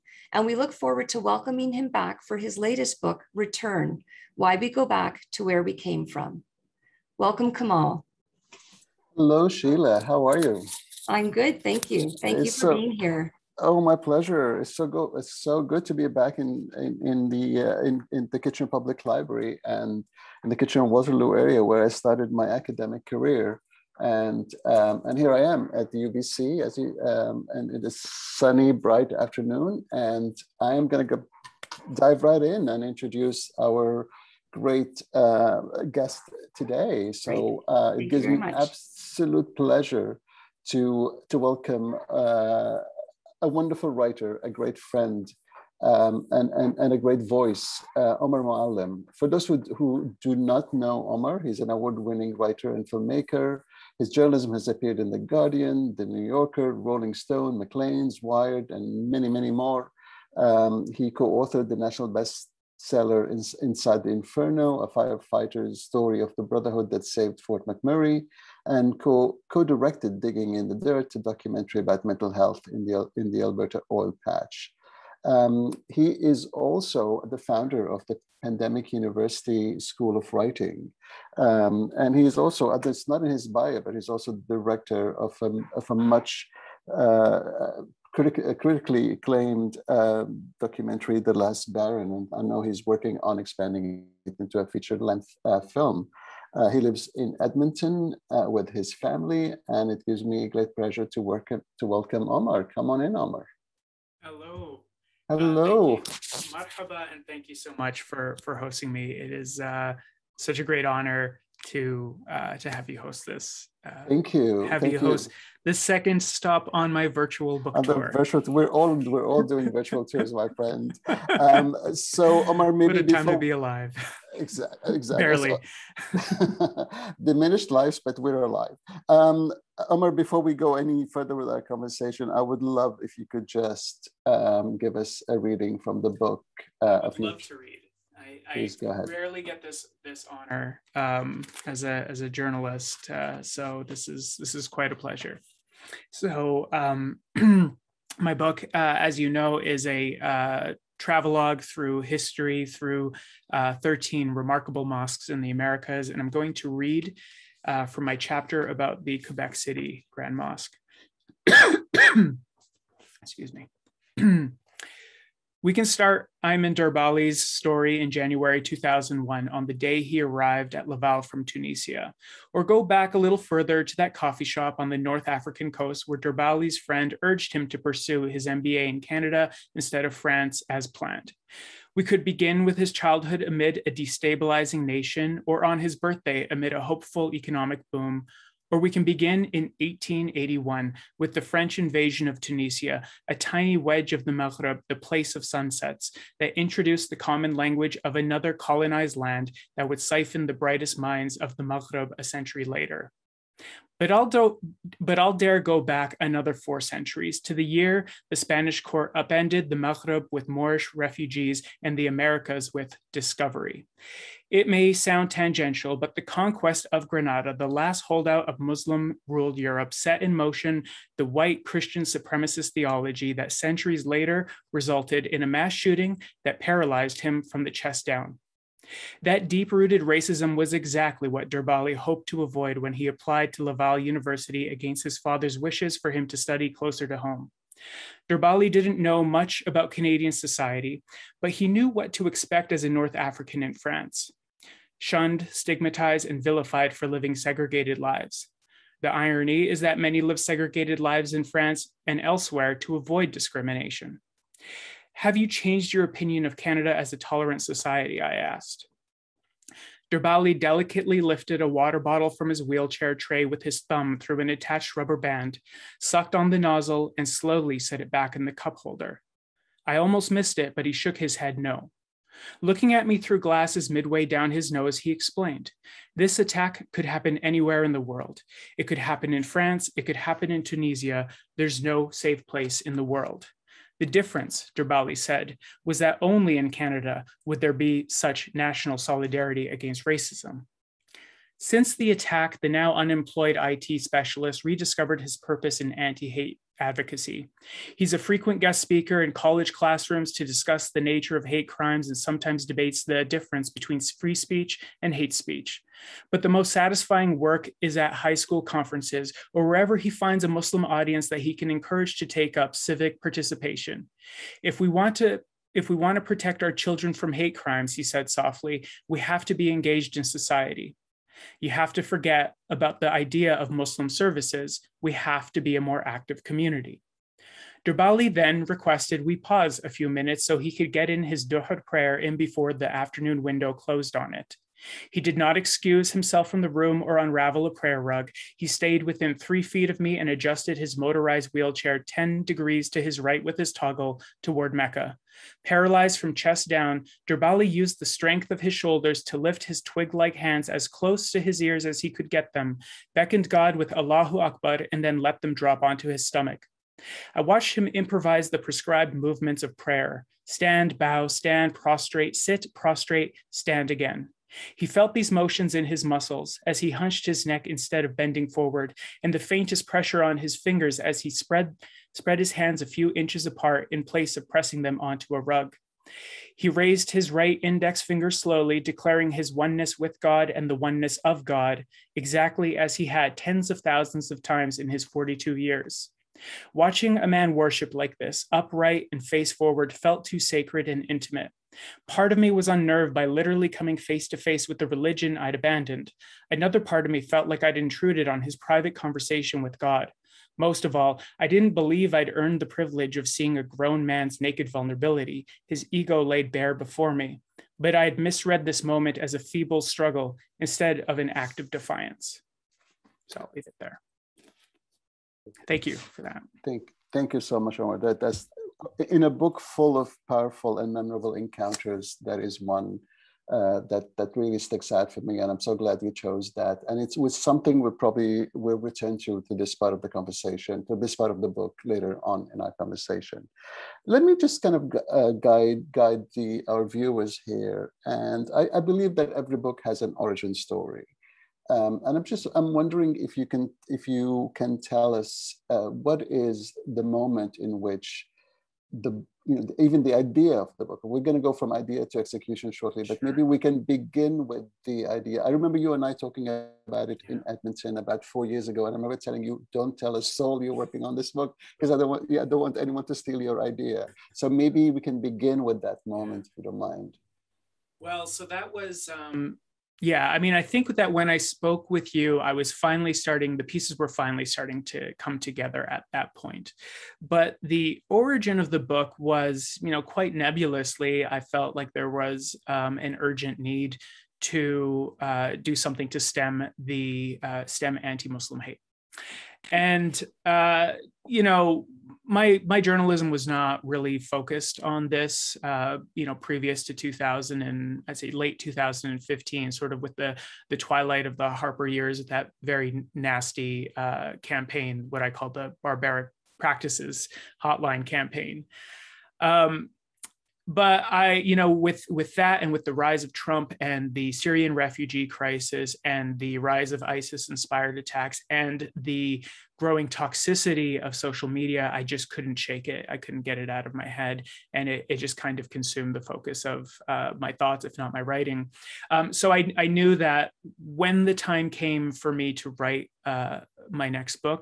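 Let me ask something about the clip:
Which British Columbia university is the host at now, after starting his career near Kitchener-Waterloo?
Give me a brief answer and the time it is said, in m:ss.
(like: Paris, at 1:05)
UBC, at 0:25.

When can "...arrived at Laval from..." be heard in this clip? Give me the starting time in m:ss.
2:50.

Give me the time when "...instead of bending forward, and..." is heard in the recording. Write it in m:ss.
6:07.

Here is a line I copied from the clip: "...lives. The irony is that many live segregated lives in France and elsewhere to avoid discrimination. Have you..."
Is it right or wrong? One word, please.
right.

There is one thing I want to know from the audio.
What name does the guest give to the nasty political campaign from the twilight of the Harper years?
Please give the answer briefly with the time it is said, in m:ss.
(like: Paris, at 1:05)
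barbaric practices hotline campaign, at 8:25.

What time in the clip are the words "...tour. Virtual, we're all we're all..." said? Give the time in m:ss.
1:57.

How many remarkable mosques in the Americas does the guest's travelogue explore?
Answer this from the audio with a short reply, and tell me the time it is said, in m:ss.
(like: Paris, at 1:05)
13, at 2:33.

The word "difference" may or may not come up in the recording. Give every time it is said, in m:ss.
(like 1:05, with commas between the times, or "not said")
4:44, 5:03.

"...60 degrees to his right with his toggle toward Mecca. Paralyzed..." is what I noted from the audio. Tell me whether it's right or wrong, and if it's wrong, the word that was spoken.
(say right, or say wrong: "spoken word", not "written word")
wrong: "10", not "60".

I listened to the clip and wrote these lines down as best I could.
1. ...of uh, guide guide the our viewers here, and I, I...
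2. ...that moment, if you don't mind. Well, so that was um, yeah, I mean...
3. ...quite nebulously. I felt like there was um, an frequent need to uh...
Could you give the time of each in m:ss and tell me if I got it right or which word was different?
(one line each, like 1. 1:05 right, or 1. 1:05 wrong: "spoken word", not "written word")
1. 7:14 right
2. 7:45 right
3. 8:00 wrong: "urgent", not "frequent".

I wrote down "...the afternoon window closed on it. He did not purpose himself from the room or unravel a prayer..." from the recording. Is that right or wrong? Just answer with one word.
wrong.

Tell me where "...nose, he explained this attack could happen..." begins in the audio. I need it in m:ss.
4:34.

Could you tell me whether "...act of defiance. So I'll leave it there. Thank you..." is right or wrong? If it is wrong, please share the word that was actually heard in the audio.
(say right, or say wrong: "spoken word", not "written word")
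right.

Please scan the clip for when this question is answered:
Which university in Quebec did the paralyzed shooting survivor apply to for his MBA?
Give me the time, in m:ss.
3:53.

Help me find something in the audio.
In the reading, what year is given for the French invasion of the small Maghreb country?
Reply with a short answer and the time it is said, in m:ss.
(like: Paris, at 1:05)
1881, at 3:09.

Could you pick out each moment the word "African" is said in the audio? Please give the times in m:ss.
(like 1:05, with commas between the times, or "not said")
2:55, 4:03.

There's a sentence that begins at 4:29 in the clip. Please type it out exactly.
I almost missed it, but he shook his head no.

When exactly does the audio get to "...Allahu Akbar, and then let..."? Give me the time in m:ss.
5:53.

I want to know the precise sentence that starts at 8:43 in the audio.
I couldn't get it out of my head.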